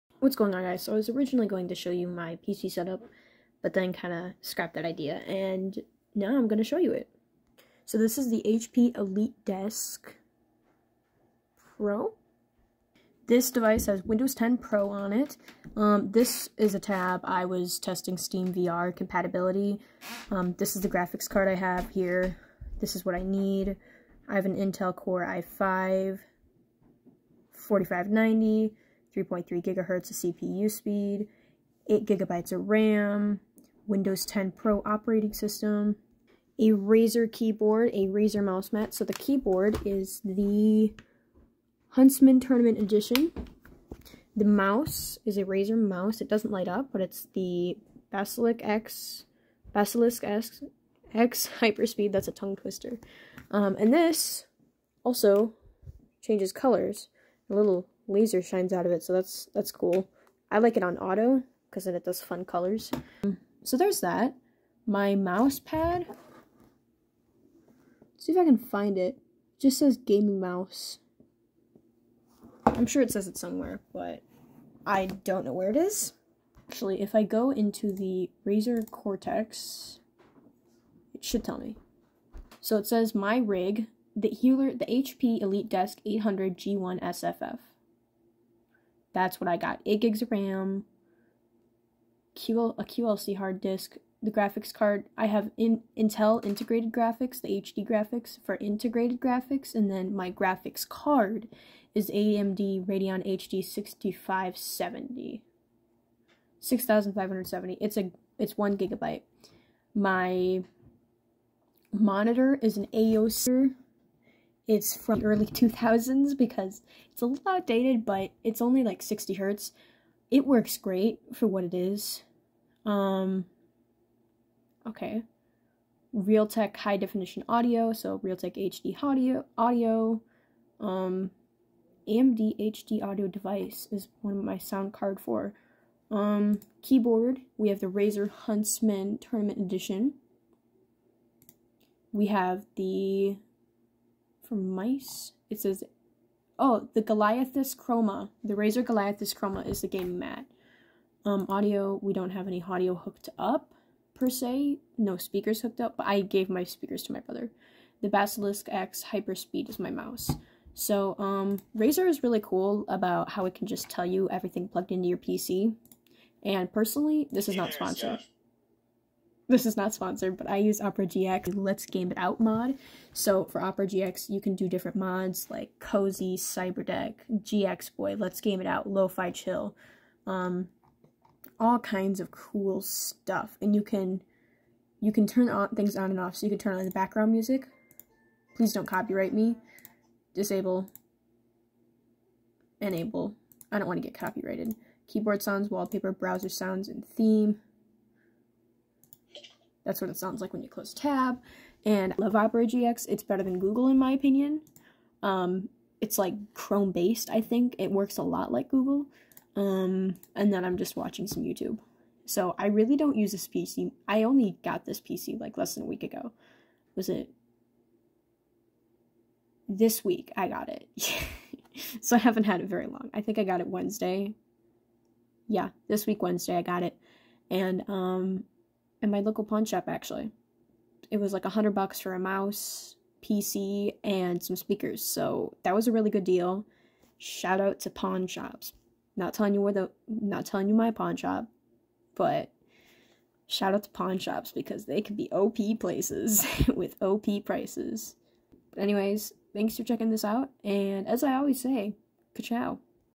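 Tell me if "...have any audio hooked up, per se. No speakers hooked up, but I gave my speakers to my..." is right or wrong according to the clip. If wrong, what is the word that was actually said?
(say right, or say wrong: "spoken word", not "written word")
right.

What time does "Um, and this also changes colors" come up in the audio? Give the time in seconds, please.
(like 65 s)
53 s.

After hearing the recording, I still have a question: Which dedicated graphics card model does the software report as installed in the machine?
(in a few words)
AMD Radeon HD 6570.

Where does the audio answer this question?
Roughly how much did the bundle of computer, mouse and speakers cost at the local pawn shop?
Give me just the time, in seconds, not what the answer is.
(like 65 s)
231 s.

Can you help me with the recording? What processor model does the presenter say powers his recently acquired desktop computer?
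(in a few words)
Intel Core i5 4590.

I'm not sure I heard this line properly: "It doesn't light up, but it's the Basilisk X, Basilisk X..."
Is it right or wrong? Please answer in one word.
right.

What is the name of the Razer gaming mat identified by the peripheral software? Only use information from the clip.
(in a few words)
Razer Goliathus Chroma.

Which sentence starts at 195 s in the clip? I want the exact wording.
Keyboard sounds, wallpaper, browser sounds, and theme.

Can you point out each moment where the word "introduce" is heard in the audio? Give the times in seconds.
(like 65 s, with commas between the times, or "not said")
not said.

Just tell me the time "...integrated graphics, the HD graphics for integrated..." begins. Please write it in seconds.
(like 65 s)
96 s.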